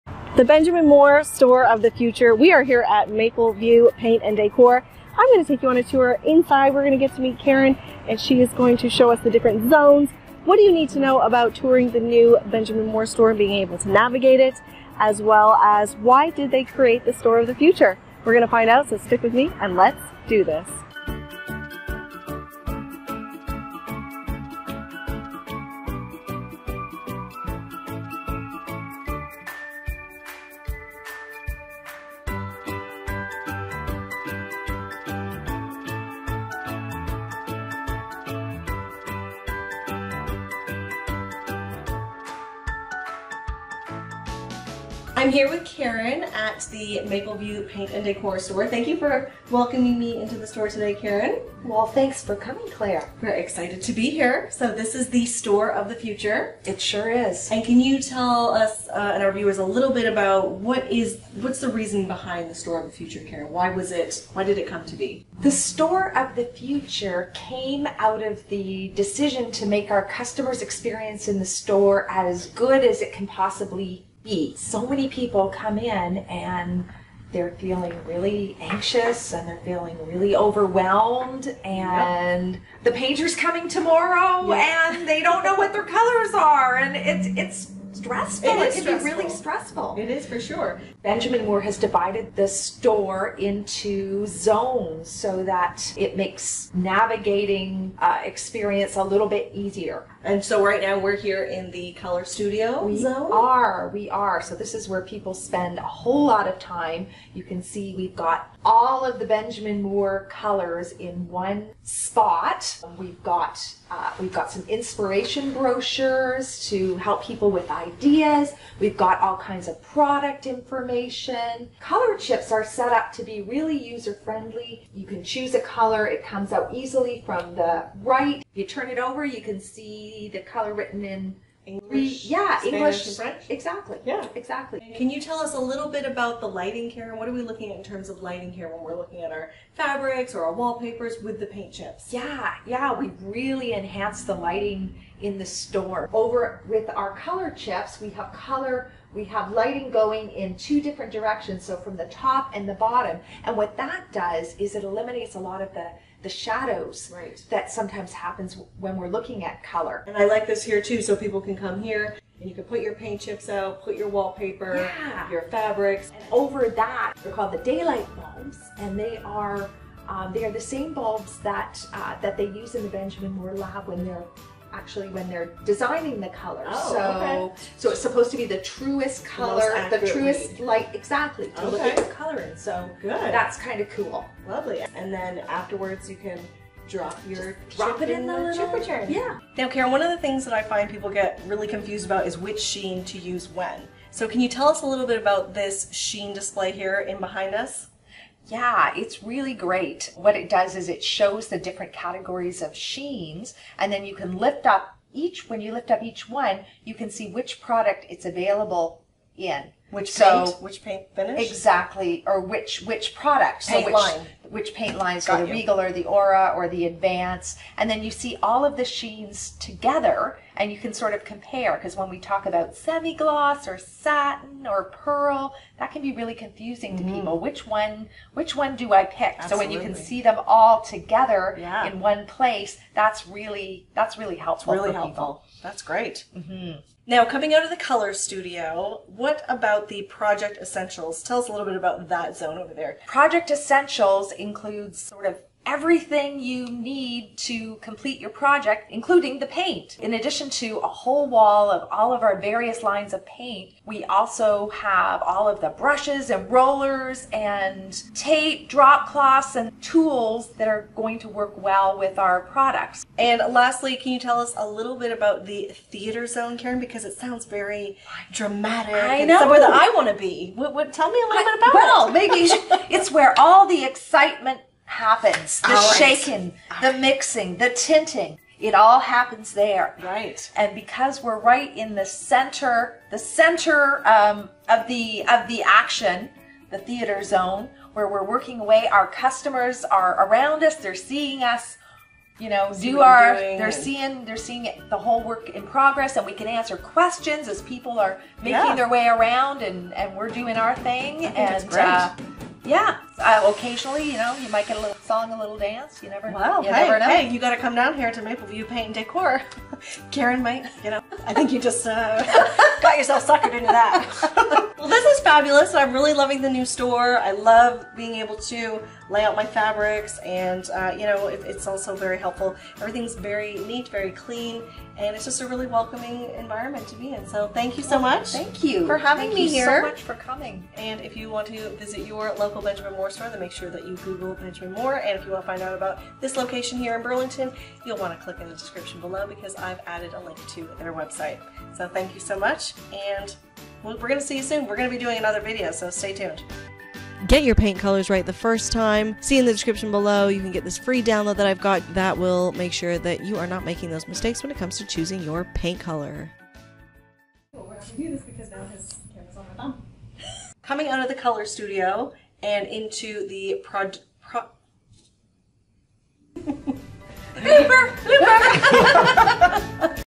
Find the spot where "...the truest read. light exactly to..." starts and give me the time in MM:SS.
02:59.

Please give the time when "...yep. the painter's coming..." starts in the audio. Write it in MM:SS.
01:22.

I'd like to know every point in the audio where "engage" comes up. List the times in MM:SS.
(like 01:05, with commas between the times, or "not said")
not said.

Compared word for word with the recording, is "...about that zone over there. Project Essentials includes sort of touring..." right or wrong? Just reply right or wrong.
wrong.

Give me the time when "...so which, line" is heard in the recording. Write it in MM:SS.
03:33.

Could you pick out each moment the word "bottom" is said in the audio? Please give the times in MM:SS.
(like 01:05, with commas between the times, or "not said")
02:32.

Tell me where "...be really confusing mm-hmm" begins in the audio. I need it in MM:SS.
03:46.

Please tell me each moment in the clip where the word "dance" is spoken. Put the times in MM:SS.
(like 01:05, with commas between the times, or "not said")
05:05.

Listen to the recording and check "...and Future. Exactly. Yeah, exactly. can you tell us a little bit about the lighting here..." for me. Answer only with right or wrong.
wrong.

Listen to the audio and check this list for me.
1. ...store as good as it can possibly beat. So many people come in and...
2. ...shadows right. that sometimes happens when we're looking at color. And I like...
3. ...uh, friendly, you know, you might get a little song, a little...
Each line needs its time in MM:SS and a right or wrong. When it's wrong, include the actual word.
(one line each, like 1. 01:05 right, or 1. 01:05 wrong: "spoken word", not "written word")
1. 01:11 right
2. 02:36 right
3. 05:03 wrong: "occasionally", not "friendly".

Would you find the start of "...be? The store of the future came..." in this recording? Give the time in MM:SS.
01:04.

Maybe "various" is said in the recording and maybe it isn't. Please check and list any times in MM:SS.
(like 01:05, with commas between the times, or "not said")
04:12.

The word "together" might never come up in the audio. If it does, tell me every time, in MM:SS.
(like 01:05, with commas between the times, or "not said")
03:39, 03:50.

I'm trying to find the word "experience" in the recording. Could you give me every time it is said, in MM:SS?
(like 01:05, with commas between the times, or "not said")
01:10, 01:38.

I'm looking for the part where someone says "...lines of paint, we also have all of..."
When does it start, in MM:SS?
04:12.